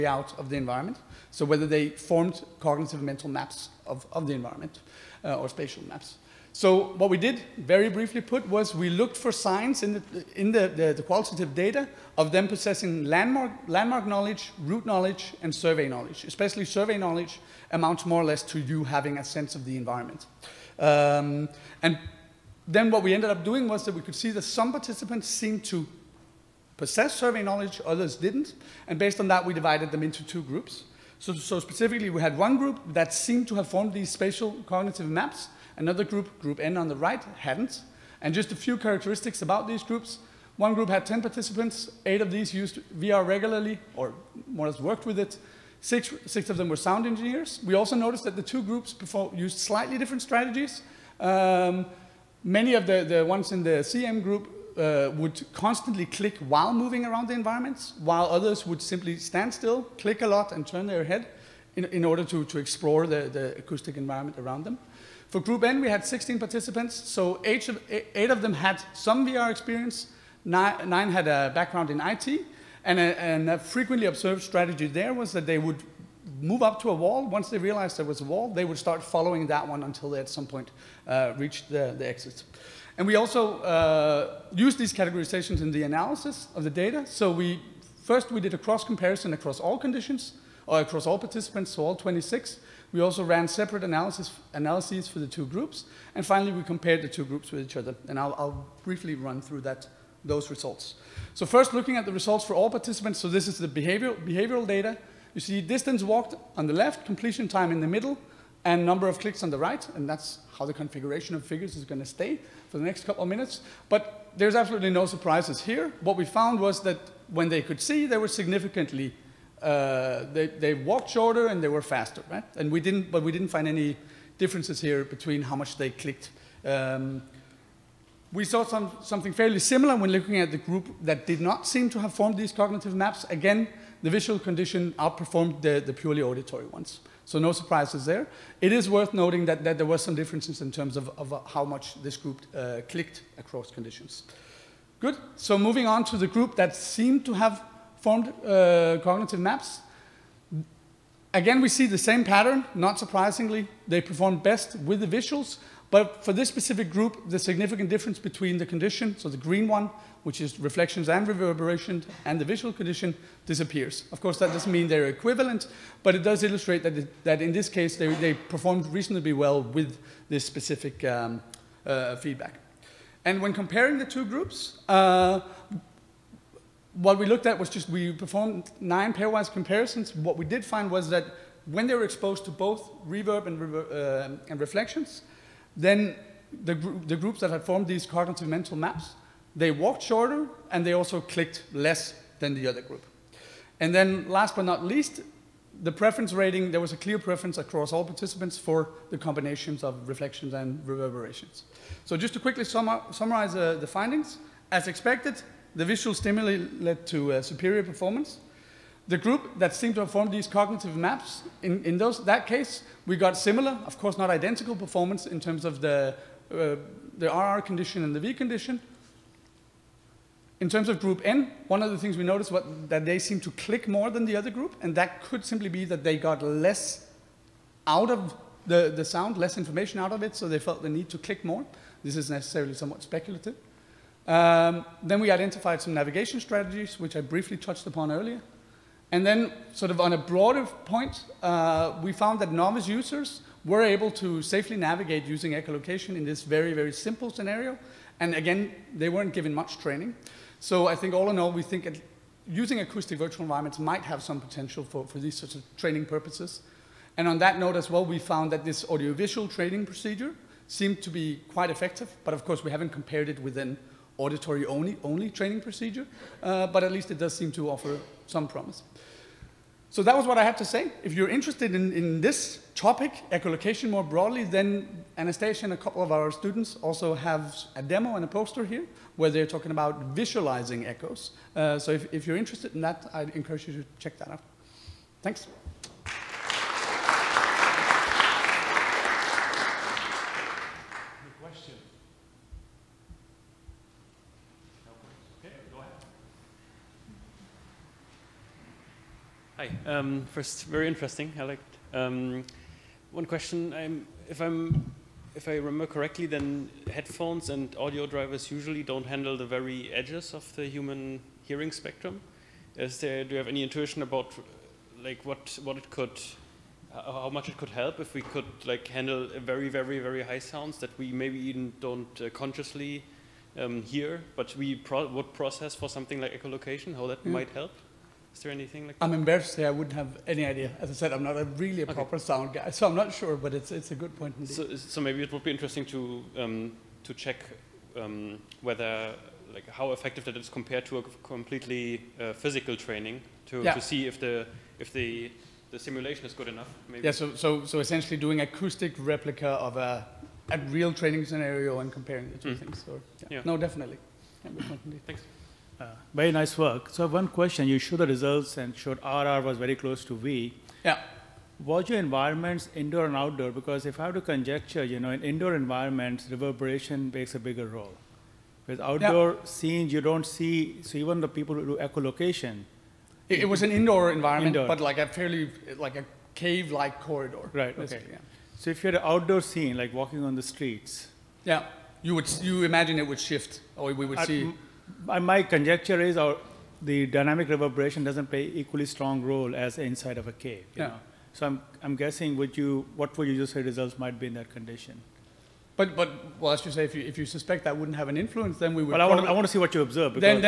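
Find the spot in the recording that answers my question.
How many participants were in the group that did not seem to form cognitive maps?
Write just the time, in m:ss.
1:05.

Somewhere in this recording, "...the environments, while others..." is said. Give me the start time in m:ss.
0:57.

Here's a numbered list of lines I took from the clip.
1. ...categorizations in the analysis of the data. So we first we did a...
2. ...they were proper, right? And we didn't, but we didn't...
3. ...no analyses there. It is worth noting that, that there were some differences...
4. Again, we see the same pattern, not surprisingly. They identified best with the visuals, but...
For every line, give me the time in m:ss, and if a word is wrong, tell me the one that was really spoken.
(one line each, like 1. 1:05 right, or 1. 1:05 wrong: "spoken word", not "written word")
1. 1:24 right
2. 2:01 wrong: "faster", not "proper"
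3. 2:17 wrong: "surprises", not "analyses"
4. 2:31 wrong: "performed", not "identified".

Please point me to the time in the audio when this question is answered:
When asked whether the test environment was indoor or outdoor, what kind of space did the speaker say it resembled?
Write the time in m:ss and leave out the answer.
6:16.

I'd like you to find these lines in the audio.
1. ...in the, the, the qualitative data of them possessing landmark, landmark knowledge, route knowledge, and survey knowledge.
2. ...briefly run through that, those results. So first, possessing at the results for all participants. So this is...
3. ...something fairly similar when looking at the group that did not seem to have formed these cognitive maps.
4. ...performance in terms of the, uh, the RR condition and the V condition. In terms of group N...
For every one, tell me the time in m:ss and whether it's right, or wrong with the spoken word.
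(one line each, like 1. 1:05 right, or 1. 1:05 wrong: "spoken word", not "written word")
1. 0:10 right
2. 1:38 wrong: "looking", not "possessing"
3. 2:09 right
4. 3:34 right.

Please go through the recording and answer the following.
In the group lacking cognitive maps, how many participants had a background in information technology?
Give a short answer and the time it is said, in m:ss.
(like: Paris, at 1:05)
9, at 1:10.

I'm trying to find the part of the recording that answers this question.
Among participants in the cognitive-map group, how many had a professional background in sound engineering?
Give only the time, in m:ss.
0:45.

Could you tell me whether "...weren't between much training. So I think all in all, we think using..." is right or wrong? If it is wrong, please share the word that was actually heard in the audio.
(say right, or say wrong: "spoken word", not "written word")
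wrong: "given", not "between".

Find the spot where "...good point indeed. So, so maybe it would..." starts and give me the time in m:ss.
5:33.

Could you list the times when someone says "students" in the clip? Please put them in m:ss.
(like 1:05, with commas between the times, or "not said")
4:36.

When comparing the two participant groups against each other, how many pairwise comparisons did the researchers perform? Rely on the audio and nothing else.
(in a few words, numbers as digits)
9.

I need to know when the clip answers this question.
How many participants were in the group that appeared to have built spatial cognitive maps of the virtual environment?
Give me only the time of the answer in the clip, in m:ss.
0:40.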